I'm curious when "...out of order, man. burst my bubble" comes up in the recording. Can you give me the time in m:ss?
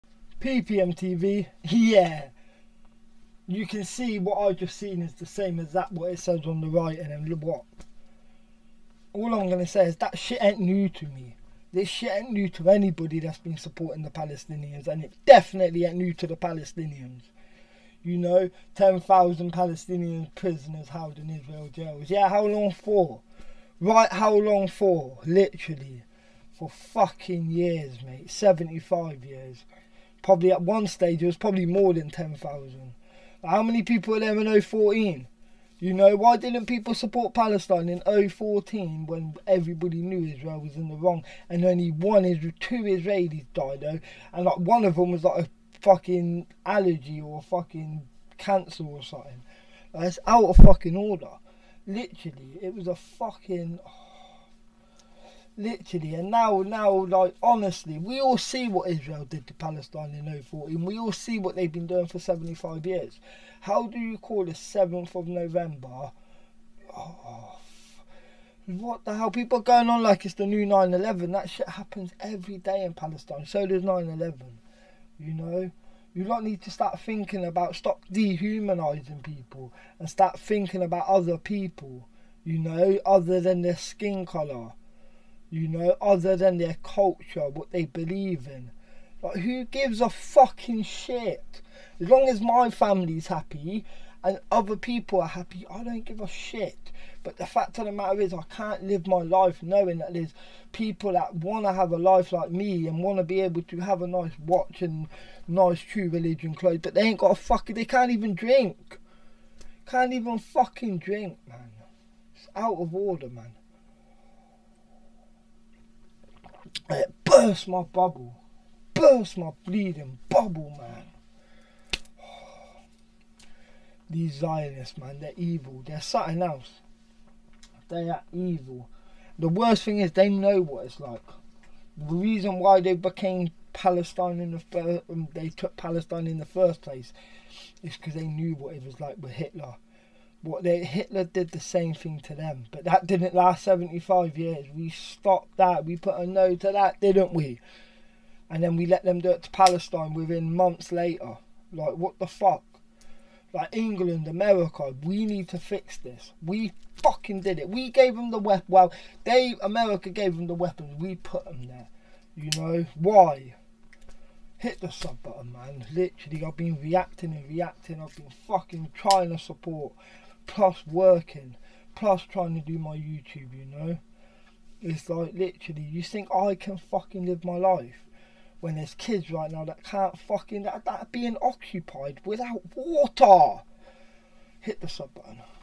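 1:52.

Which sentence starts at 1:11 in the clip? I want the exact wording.
That shit happens every day in Palestine.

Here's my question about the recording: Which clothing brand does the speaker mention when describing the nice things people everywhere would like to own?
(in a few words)
True Religion.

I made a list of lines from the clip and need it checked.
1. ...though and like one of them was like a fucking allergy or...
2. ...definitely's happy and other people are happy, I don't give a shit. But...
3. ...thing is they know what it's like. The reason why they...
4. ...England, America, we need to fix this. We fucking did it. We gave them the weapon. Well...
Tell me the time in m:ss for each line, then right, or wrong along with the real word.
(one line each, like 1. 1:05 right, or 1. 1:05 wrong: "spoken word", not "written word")
1. 0:43 right
2. 1:32 wrong: "family", not "definitely"
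3. 2:09 right
4. 2:33 right.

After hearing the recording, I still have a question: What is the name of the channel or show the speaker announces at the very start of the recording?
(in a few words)
PPM TV.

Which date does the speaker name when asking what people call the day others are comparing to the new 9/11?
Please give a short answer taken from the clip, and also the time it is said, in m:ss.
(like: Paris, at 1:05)
7th of November, at 1:04.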